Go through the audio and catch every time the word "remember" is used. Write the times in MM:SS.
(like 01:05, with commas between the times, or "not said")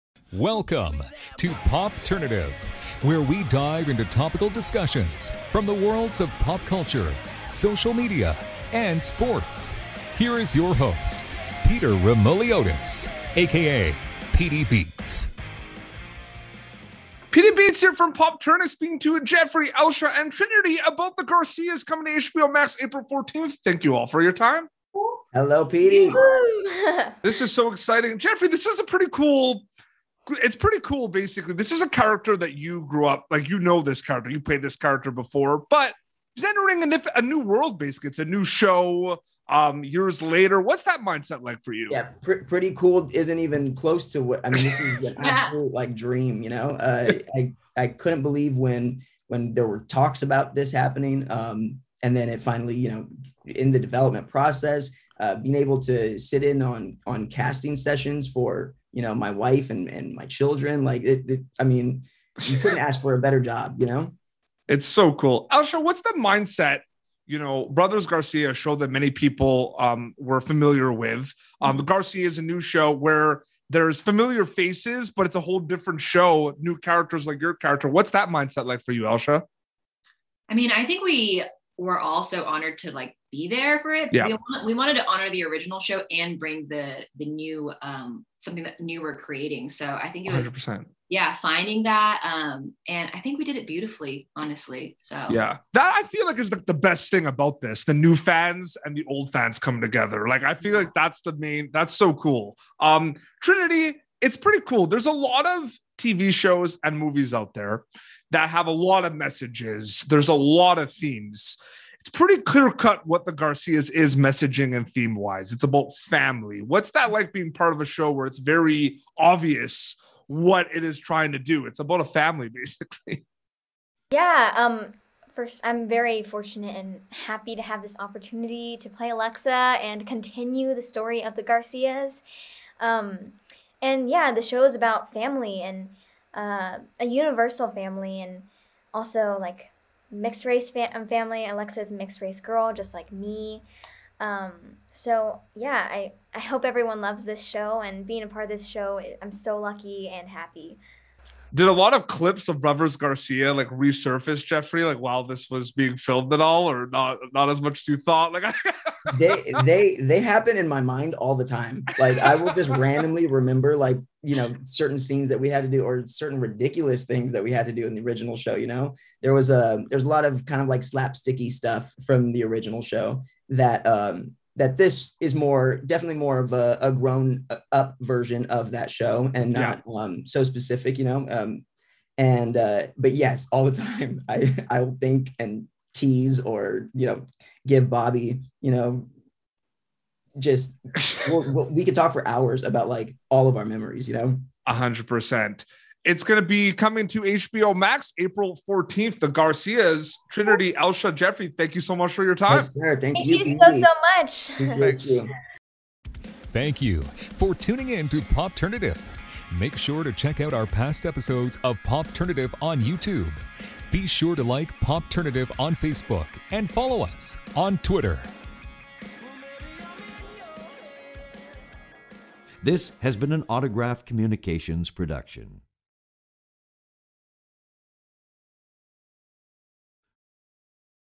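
02:43.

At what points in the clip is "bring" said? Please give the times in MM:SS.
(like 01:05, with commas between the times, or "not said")
01:26.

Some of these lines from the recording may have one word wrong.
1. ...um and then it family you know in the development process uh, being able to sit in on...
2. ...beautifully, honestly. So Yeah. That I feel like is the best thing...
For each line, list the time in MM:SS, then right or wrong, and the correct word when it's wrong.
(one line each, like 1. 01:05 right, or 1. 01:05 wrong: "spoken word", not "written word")
1. 00:51 wrong: "finally", not "family"
2. 01:33 right.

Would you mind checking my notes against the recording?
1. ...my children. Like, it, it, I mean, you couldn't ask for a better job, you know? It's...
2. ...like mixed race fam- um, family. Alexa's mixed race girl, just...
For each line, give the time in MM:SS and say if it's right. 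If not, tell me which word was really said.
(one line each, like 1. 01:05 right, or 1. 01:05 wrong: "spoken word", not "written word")
1. 01:00 right
2. 02:19 right.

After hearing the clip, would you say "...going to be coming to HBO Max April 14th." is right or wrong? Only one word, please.
right.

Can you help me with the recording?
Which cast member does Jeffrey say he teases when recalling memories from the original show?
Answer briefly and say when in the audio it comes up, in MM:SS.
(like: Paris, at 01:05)
Bobby, at 03:07.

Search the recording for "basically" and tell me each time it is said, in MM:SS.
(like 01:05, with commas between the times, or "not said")
00:31, 00:37, 02:02.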